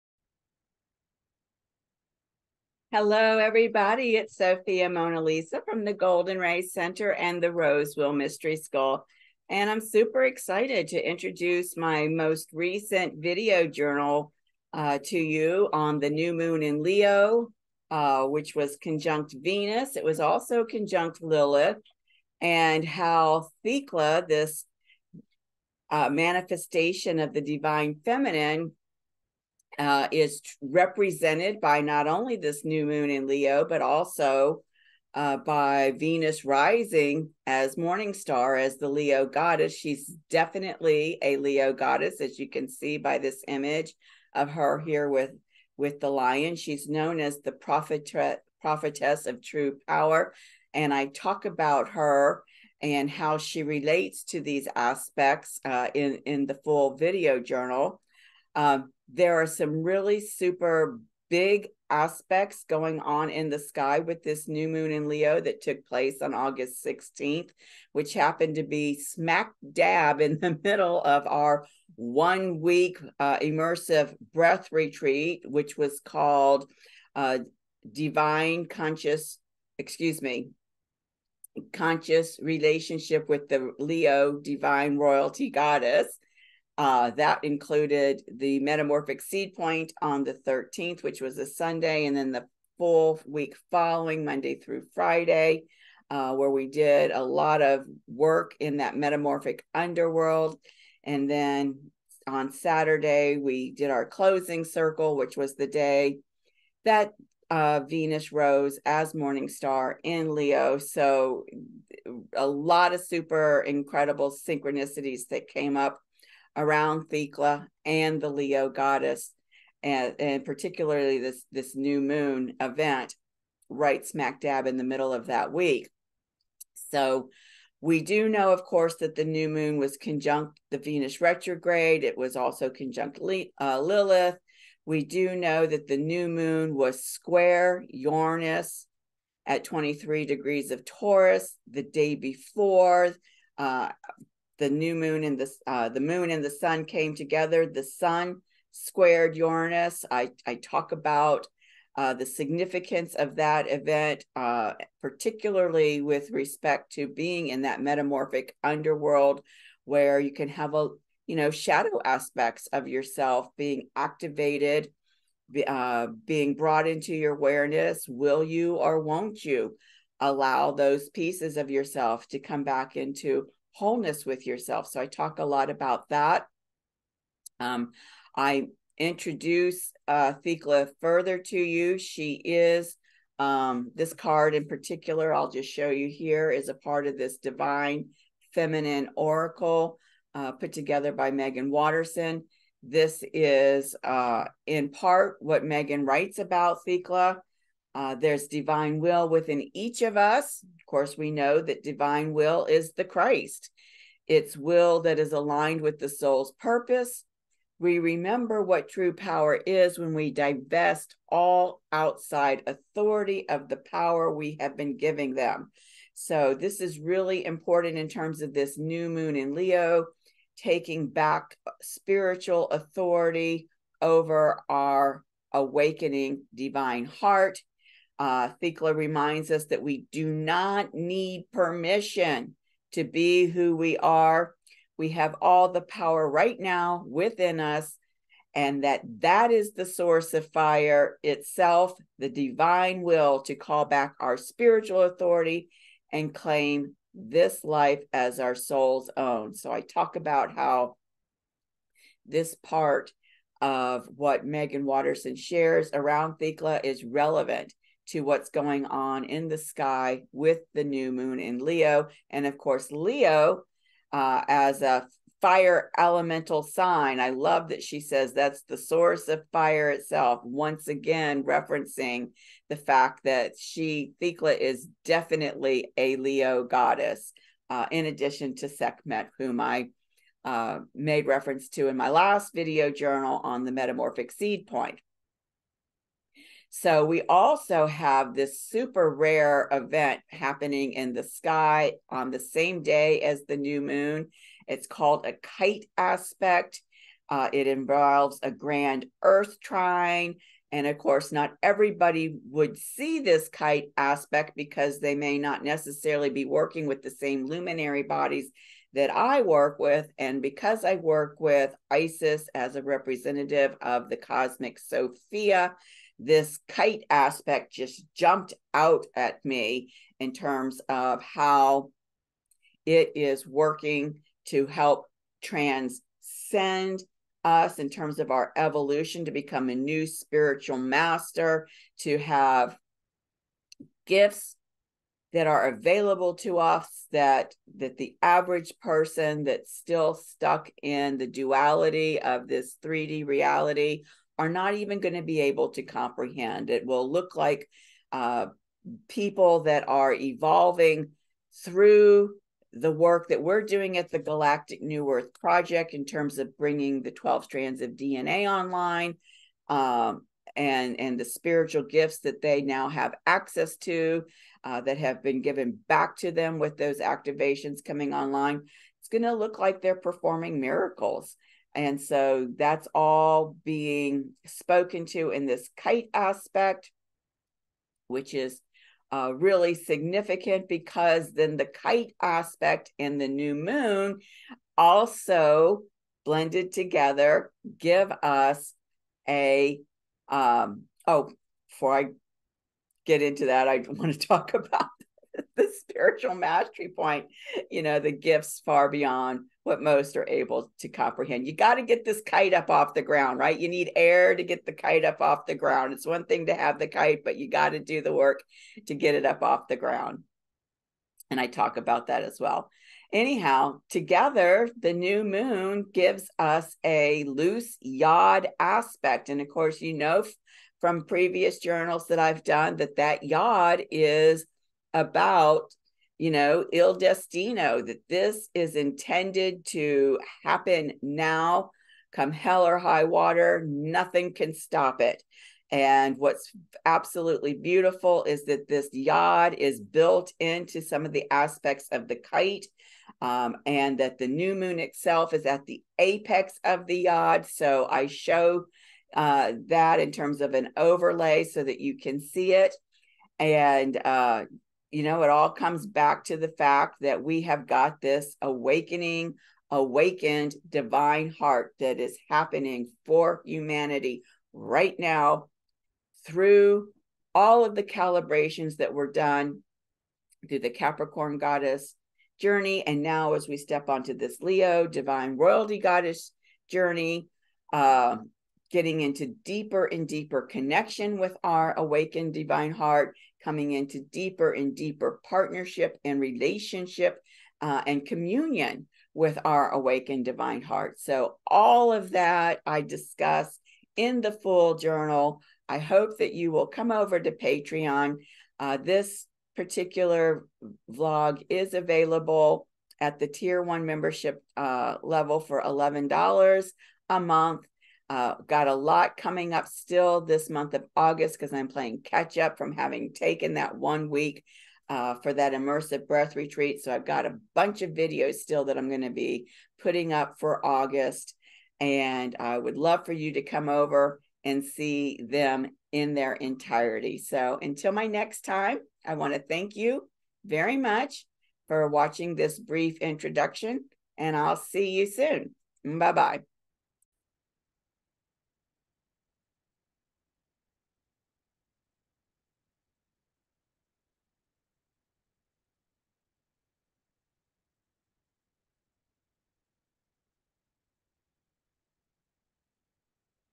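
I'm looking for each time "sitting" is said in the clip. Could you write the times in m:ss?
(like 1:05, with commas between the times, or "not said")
not said.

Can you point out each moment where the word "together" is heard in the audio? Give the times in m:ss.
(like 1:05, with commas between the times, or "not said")
2:27, 3:10, 6:26, 6:53.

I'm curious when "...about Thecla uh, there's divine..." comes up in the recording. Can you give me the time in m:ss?
3:16.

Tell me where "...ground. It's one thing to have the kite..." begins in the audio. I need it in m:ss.
6:45.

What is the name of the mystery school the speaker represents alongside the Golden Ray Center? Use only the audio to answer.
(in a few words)
Rose Wheel Mystery School.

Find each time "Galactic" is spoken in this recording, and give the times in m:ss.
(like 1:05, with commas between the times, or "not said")
5:54.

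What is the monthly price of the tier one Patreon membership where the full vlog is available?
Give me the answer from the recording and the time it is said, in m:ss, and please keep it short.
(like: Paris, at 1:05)
$11, at 8:25.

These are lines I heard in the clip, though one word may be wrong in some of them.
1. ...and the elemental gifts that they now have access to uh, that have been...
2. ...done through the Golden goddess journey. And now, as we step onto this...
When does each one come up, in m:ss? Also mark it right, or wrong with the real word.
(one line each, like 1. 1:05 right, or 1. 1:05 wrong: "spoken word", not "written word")
1. 6:00 wrong: "spiritual", not "elemental"
2. 7:49 wrong: "Capricorn", not "Golden".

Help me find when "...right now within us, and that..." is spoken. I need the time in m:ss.
3:56.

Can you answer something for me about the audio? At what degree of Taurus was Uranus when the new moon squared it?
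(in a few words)
23 degrees.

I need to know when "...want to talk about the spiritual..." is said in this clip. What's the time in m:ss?
6:33.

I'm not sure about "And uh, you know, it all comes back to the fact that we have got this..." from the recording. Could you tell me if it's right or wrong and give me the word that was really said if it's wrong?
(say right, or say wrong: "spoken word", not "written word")
right.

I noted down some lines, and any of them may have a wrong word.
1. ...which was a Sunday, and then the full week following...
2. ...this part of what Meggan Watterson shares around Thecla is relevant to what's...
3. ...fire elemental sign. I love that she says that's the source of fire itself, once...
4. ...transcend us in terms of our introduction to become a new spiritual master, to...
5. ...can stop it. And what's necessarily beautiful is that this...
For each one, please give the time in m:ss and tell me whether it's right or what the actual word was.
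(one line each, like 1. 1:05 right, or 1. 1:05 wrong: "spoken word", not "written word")
1. 1:31 right
2. 4:12 right
3. 4:25 right
4. 5:25 wrong: "evolution", not "introduction"
5. 7:14 wrong: "absolutely", not "necessarily".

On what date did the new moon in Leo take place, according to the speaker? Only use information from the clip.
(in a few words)
August 16th.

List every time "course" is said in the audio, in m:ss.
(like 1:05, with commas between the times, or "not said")
2:08, 3:20, 4:22, 5:00, 6:59.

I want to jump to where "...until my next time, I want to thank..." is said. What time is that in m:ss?
8:47.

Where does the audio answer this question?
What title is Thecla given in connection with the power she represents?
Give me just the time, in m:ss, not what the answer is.
0:48.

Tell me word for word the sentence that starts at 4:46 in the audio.
So we also have this super rare event happening in the sky on the same day as the new moon.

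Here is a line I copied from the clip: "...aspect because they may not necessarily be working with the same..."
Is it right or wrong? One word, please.
right.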